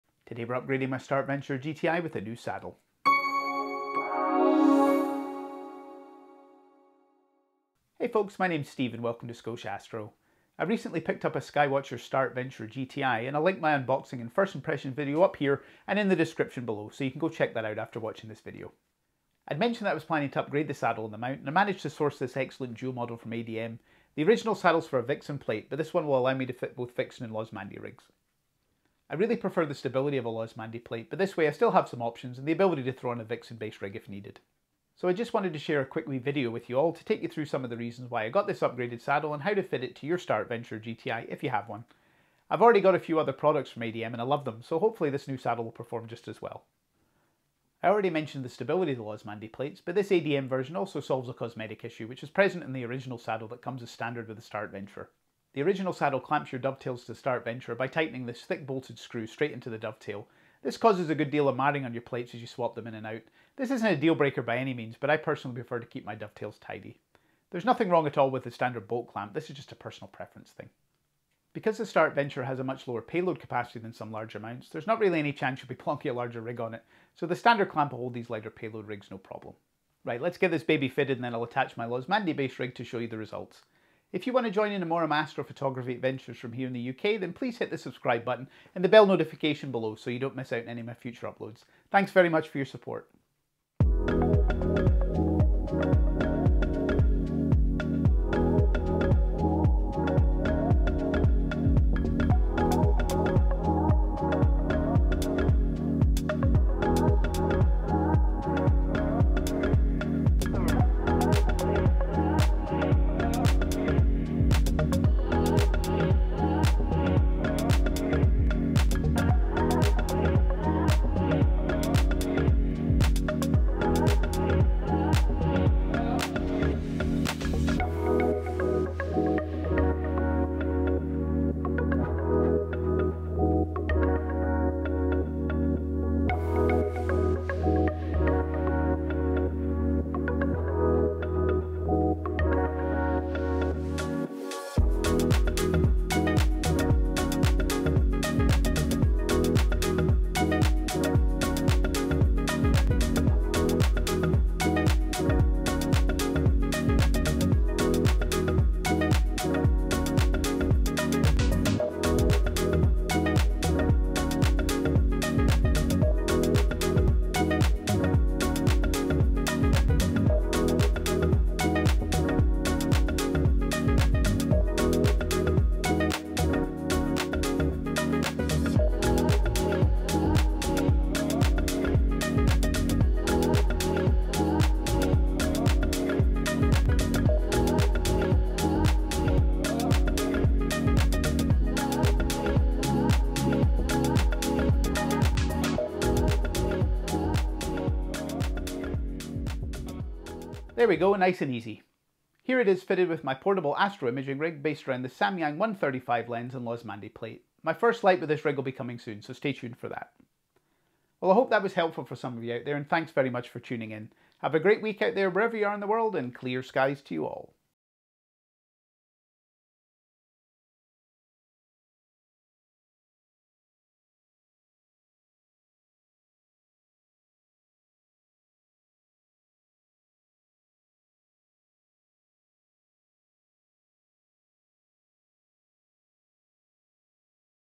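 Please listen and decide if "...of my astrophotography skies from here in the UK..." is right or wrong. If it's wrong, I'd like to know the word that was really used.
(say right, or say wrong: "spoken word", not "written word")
wrong: "adventures", not "skies".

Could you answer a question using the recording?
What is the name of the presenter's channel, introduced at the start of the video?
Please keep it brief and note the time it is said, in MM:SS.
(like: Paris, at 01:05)
Scotia Astro, at 00:09.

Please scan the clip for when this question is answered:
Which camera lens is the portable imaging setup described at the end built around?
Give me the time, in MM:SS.
03:25.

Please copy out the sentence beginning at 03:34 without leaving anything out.
Have a great week out there wherever you are in the world, and clear skies to you all.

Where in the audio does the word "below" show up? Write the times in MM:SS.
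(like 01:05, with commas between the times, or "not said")
00:16, 01:29.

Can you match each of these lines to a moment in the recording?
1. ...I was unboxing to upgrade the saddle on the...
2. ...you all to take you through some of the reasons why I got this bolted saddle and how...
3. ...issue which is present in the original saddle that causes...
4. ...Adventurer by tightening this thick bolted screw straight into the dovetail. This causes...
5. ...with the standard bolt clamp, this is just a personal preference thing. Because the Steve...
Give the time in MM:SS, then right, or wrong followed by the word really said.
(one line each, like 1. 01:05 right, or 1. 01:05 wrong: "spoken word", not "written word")
1. 00:19 wrong: "planning", not "unboxing"
2. 00:36 wrong: "upgraded", not "bolted"
3. 00:51 wrong: "comes", not "causes"
4. 00:57 right
5. 01:08 wrong: "Star", not "Steve".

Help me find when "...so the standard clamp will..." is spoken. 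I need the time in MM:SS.
01:17.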